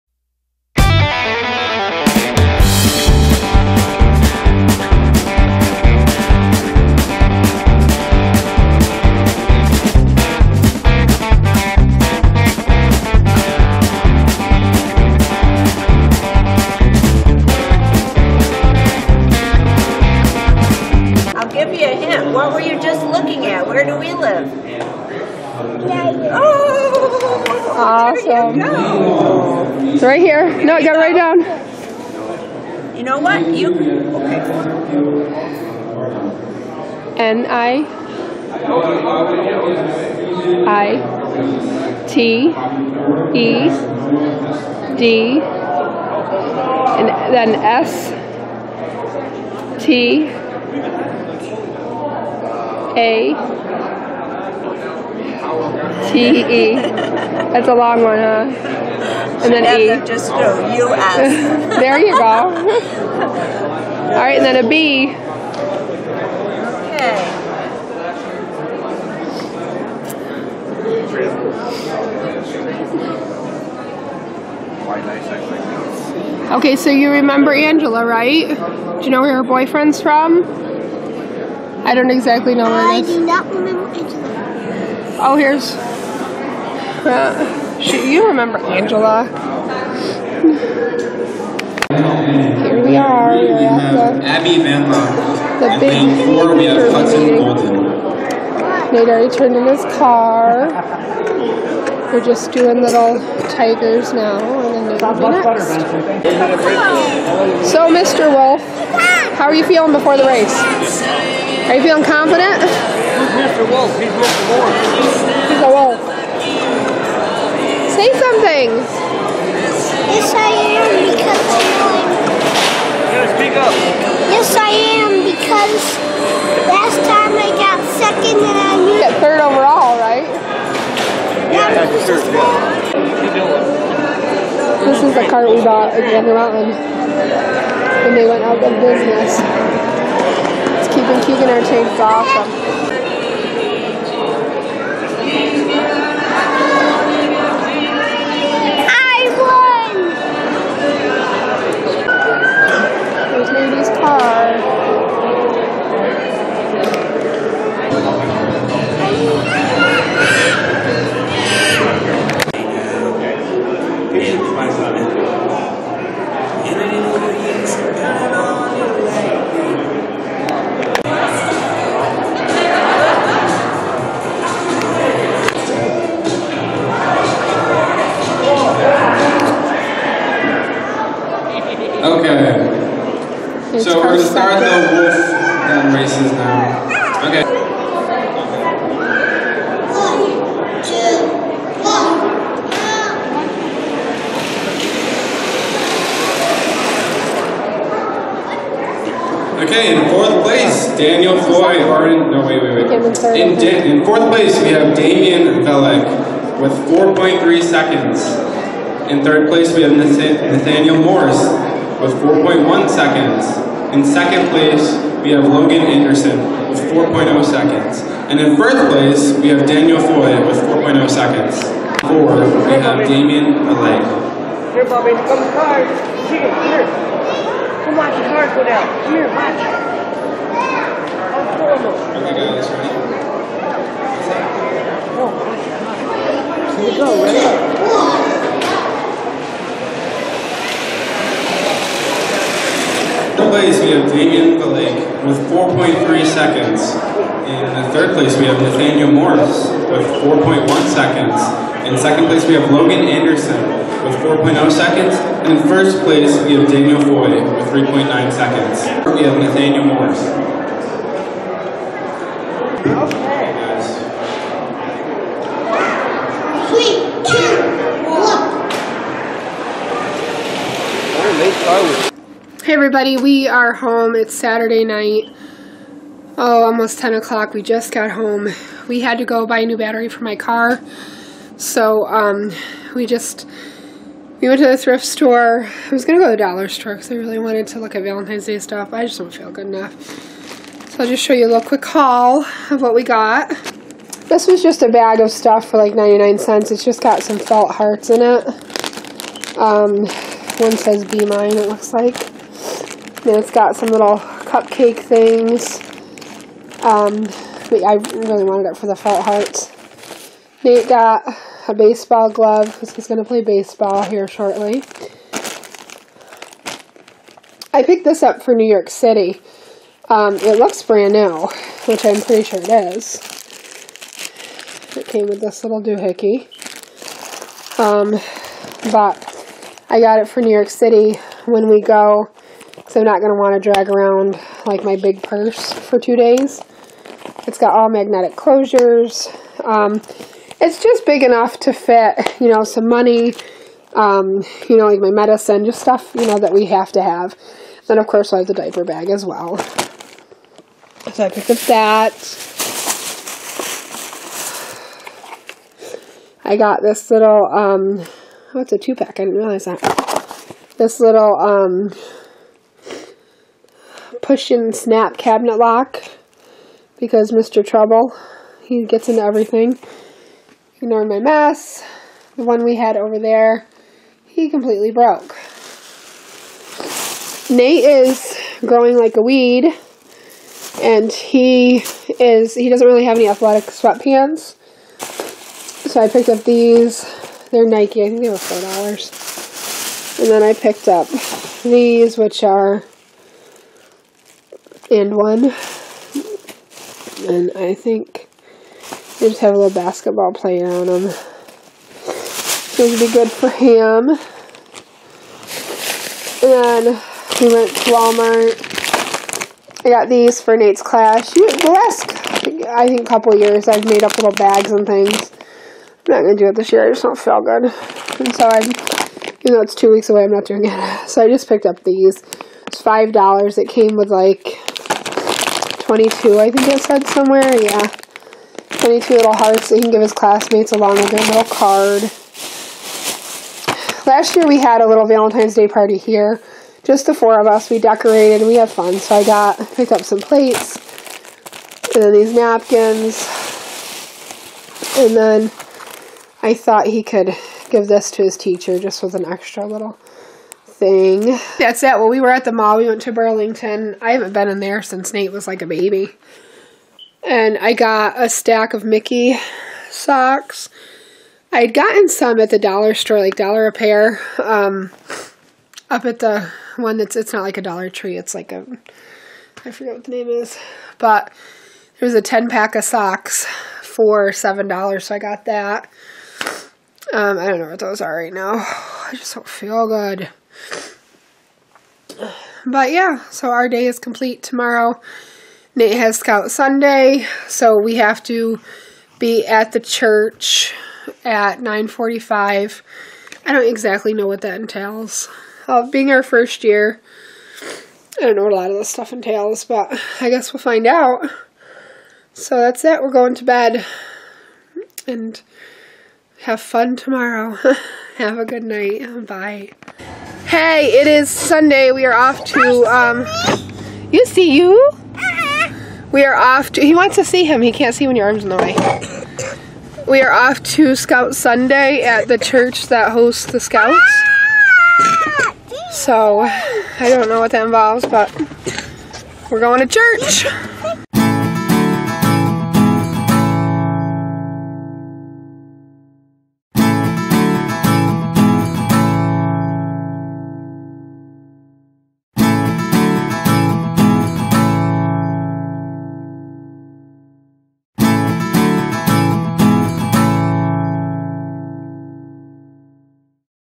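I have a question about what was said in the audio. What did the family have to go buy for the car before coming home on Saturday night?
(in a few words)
a new battery.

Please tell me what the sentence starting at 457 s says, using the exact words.
And I got a stack of Mickey socks.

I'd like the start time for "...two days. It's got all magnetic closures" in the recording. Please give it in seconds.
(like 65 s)
335 s.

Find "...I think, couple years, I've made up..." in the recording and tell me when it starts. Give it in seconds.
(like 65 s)
412 s.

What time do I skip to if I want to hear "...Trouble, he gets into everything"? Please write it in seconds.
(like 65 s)
367 s.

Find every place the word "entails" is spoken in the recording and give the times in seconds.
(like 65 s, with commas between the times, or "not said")
494 s, 499 s.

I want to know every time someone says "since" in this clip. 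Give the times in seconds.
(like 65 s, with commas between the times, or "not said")
454 s.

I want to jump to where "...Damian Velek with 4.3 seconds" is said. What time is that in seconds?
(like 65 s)
204 s.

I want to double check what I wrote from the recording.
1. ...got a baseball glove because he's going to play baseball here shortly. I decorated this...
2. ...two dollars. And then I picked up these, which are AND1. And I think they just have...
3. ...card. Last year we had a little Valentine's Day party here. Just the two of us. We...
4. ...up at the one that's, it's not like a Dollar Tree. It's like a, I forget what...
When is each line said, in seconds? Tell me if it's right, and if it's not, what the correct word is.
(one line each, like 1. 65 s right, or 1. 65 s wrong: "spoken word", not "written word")
1. 310 s wrong: "picked", not "decorated"
2. 388 s wrong: "four", not "two"
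3. 431 s wrong: "four", not "two"
4. 465 s right.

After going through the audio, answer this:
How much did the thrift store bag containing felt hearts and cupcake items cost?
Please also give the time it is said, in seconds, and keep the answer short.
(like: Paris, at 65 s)
99 cents, at 295 s.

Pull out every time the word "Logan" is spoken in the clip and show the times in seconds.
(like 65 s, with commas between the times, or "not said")
215 s, 252 s.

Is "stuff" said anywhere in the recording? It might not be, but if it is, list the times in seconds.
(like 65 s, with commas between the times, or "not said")
288 s, 295 s, 345 s, 498 s.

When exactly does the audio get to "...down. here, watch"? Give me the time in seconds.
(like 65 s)
228 s.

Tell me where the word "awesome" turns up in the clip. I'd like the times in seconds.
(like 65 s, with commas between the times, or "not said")
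27 s, 142 s.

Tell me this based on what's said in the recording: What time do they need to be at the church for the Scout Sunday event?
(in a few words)
9:45.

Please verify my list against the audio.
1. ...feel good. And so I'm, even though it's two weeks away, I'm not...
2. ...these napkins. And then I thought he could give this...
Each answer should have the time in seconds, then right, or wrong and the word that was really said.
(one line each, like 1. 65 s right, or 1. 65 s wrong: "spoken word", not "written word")
1. 417 s right
2. 442 s right.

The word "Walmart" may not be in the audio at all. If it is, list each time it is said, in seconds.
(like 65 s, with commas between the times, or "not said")
407 s.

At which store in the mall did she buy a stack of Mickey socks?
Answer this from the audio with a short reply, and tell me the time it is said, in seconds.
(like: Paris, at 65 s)
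Burlington, at 453 s.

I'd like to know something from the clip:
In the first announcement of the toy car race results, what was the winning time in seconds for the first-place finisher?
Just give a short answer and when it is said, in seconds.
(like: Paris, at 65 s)
4.0 seconds, at 220 s.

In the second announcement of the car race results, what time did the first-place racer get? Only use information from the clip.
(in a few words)
3.9 seconds.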